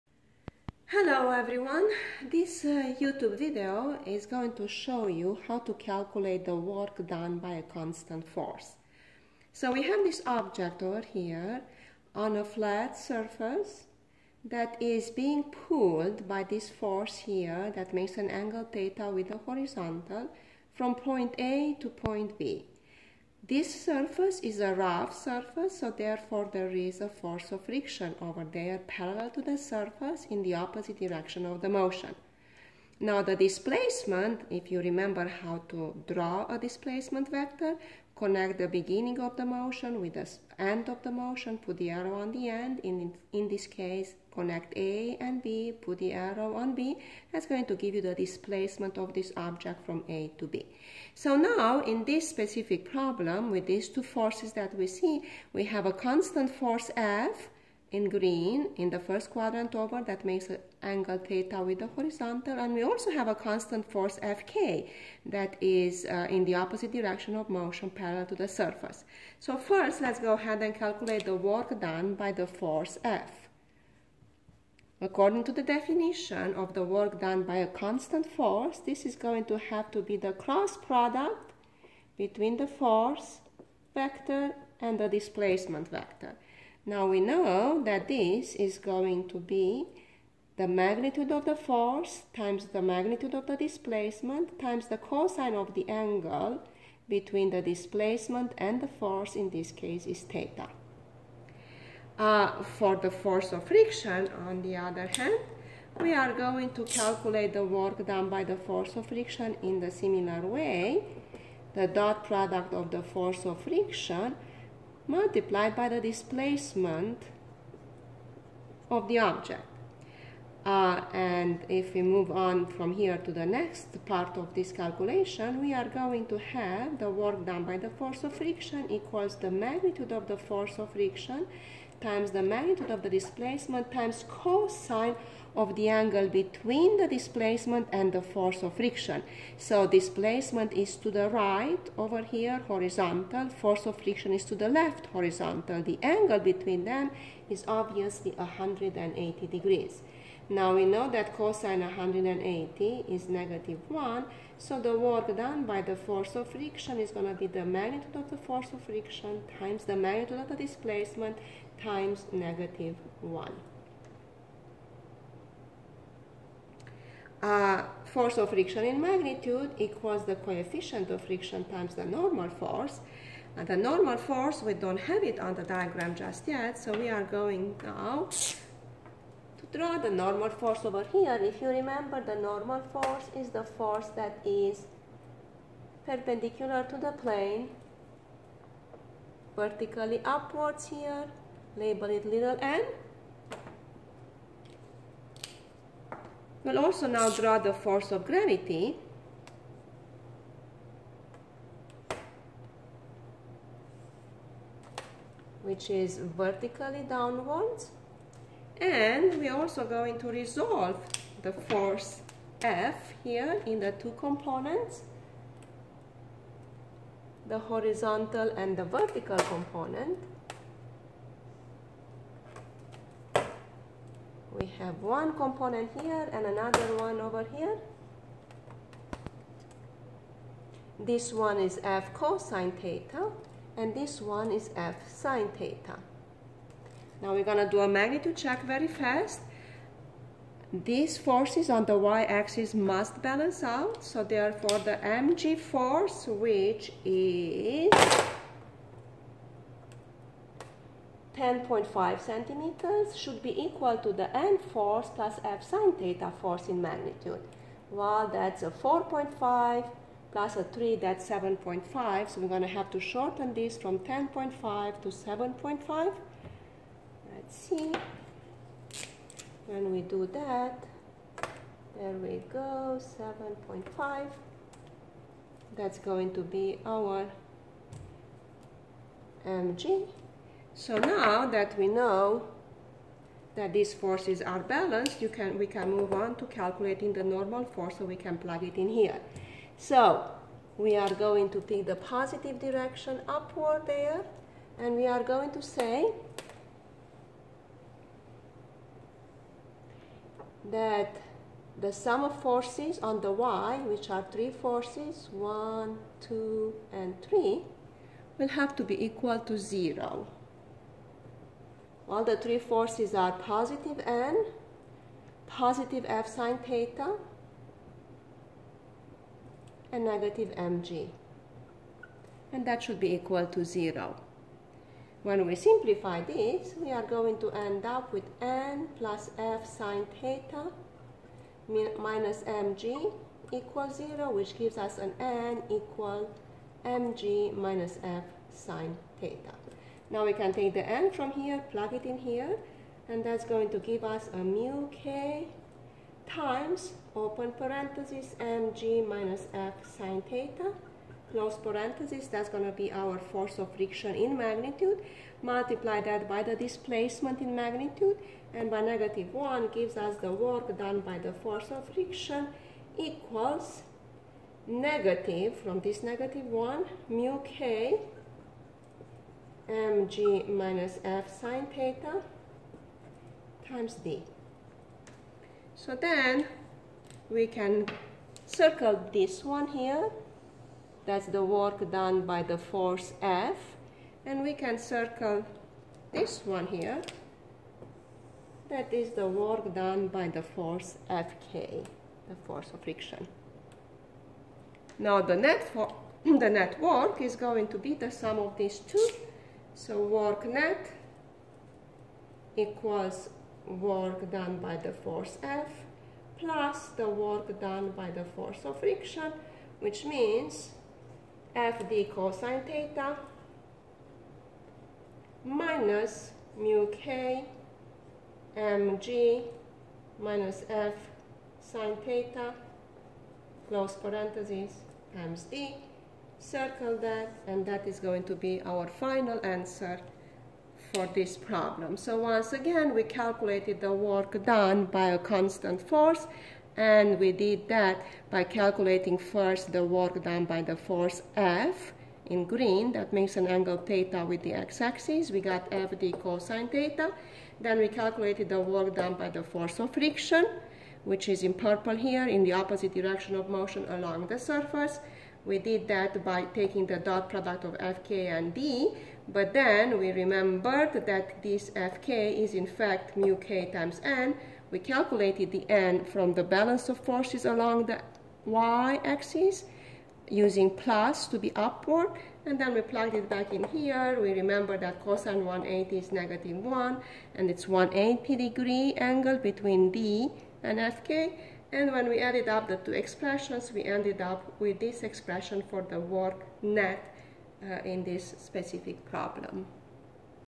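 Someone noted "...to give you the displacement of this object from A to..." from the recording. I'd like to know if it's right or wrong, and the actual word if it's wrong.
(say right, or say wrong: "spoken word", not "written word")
right.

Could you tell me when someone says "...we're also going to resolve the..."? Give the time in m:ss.
3:29.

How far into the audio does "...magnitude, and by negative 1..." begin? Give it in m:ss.
5:57.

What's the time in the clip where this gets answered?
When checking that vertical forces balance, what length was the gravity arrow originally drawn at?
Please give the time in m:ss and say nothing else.
4:11.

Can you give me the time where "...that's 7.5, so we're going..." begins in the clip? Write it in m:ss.
4:20.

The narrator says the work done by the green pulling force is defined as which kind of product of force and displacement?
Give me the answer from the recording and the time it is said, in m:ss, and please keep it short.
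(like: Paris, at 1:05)
Cross product, at 1:20.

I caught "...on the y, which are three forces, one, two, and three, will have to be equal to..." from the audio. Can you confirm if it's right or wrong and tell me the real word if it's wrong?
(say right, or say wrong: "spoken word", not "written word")
right.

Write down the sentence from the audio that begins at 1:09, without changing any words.
So first let's go ahead and calculate the work done by the force F.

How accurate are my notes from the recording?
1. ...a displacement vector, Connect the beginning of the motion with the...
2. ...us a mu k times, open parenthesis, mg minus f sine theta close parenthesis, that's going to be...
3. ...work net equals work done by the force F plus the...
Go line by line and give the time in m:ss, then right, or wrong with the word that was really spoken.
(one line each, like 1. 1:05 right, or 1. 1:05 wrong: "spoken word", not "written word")
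1. 0:36 right
2. 5:44 right
3. 6:39 right.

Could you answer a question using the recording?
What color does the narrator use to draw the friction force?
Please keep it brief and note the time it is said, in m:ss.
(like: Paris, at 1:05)
Purple, at 7:31.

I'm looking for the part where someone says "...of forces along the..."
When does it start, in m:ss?
7:46.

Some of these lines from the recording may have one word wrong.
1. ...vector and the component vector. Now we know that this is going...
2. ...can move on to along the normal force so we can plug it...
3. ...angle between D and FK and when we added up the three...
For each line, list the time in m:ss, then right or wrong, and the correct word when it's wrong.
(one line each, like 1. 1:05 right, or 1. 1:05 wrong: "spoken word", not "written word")
1. 1:23 wrong: "displacement", not "component"
2. 4:45 wrong: "calculating", not "along"
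3. 7:58 wrong: "two", not "three".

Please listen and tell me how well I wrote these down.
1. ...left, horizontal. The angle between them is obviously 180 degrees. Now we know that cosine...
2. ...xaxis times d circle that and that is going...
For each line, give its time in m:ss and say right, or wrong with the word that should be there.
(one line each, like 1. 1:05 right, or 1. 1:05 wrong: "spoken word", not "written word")
1. 2:24 right
2. 7:03 wrong: "parenthesis", not "xaxis".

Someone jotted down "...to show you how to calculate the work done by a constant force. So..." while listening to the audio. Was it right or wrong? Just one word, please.
right.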